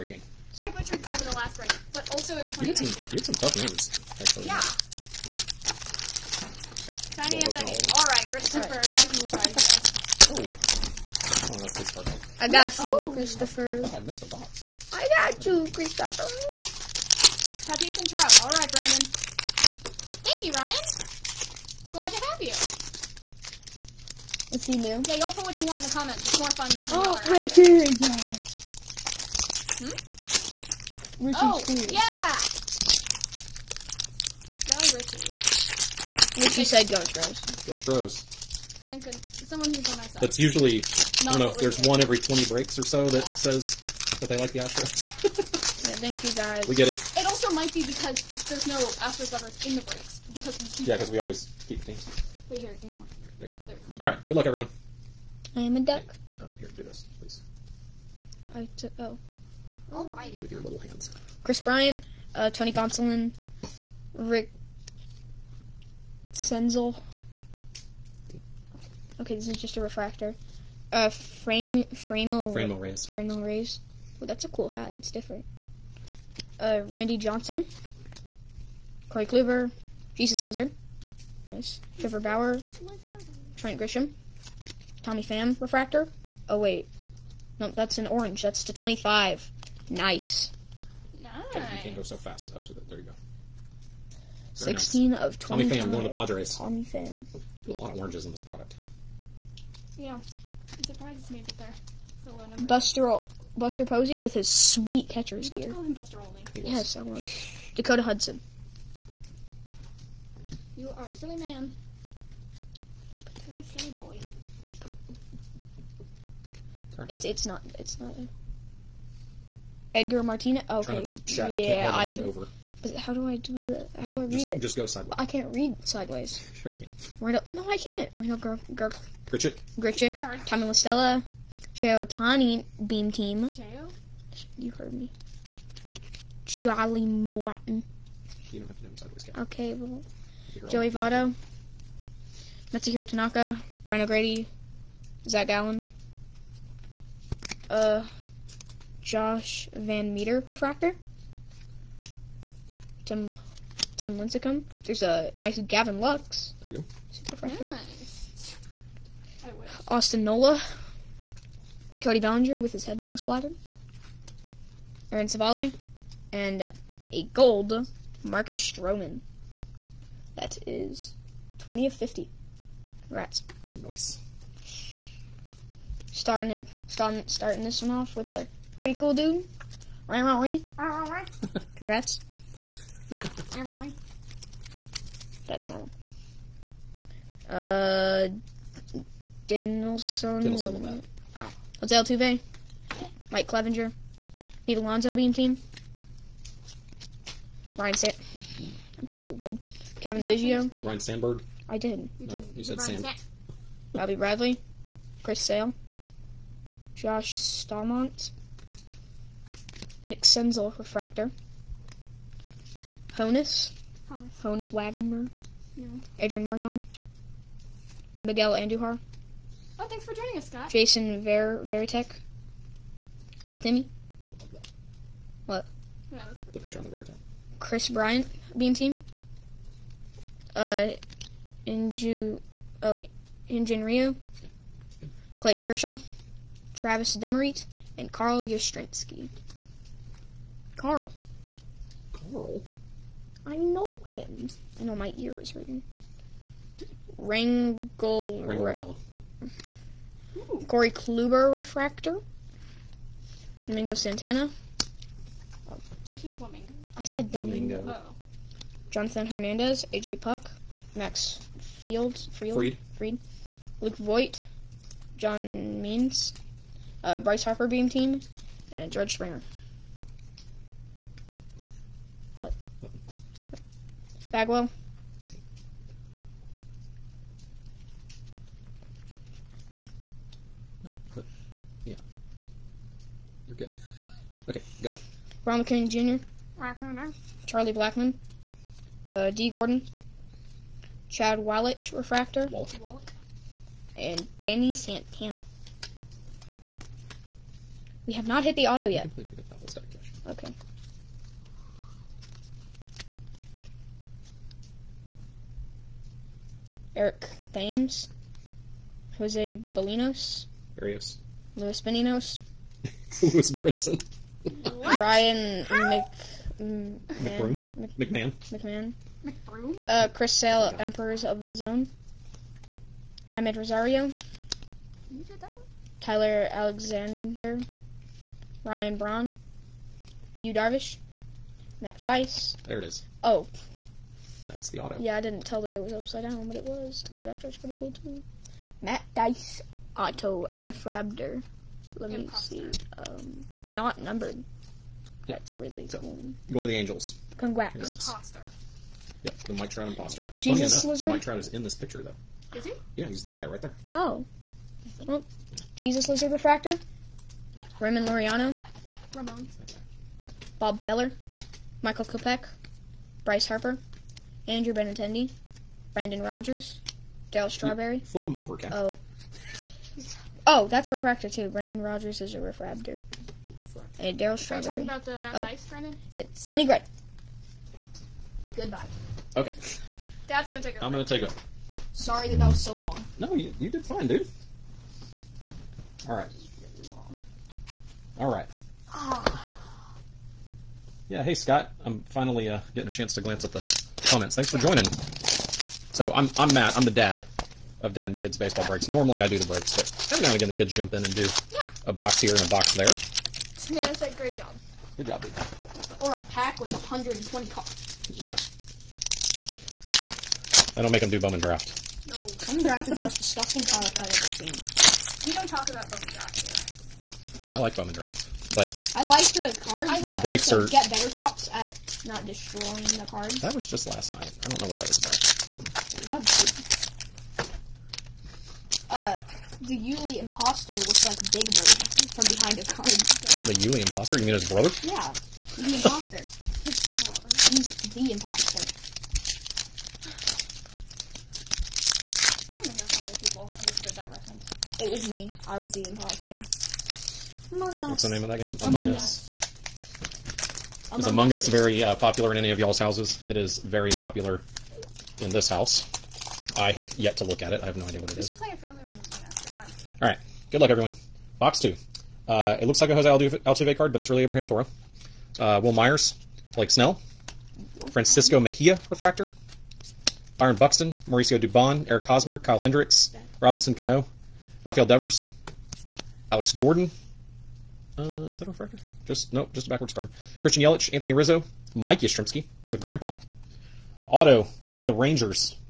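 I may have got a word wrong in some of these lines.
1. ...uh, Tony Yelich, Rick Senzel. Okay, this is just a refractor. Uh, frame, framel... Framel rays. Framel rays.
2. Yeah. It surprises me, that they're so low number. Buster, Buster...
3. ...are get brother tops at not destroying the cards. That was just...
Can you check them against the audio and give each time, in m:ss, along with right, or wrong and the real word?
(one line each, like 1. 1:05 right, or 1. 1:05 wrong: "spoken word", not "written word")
1. 1:02 wrong: "Gonsolin", not "Yelich"
2. 1:39 right
3. 7:00 wrong: "better", not "brother".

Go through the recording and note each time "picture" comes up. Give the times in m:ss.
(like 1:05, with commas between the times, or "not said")
3:46, 5:51.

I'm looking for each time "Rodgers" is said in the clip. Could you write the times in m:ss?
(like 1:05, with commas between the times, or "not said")
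6:06, 6:11.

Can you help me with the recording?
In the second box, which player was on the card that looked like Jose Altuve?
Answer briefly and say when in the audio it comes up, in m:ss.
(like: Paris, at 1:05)
Abraham Toro, at 7:44.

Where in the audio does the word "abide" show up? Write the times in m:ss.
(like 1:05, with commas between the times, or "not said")
not said.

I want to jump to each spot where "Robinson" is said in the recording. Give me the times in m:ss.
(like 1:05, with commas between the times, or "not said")
7:53.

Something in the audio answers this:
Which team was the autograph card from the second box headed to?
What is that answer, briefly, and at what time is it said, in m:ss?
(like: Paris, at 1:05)
Rangers, at 8:04.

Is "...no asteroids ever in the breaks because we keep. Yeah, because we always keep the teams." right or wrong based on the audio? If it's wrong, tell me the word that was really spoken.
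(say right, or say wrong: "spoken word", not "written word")
right.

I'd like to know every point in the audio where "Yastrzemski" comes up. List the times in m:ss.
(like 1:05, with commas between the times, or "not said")
3:58, 8:01.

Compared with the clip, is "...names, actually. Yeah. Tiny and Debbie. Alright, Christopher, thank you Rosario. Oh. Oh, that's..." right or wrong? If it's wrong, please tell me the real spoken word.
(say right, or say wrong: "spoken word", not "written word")
wrong: "Ryan", not "Rosario".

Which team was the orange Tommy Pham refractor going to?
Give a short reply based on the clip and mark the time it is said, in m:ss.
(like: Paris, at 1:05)
Padres, at 1:36.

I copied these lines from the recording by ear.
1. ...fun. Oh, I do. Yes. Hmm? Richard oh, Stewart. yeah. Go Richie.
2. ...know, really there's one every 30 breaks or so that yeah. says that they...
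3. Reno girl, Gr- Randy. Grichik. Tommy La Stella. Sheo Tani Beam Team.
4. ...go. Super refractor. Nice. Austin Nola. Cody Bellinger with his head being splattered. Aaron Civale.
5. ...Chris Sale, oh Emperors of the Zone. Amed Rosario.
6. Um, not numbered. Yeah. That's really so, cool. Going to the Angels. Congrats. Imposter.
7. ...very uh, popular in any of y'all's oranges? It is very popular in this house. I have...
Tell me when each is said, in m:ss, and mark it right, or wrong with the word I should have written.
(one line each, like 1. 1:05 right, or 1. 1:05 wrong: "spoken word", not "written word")
1. 0:26 right
2. 0:41 wrong: "20", not "30"
3. 2:08 wrong: "Grichik", not "Randy"
4. 2:36 right
5. 5:20 right
6. 5:42 right
7. 7:31 wrong: "houses", not "oranges".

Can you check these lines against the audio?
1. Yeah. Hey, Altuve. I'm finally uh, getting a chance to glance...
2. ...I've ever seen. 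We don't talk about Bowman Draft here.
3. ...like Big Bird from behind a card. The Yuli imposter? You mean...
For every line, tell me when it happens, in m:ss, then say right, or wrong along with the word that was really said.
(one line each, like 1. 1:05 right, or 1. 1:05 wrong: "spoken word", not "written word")
1. 6:31 wrong: "Scott", not "Altuve"
2. 6:53 right
3. 7:11 right.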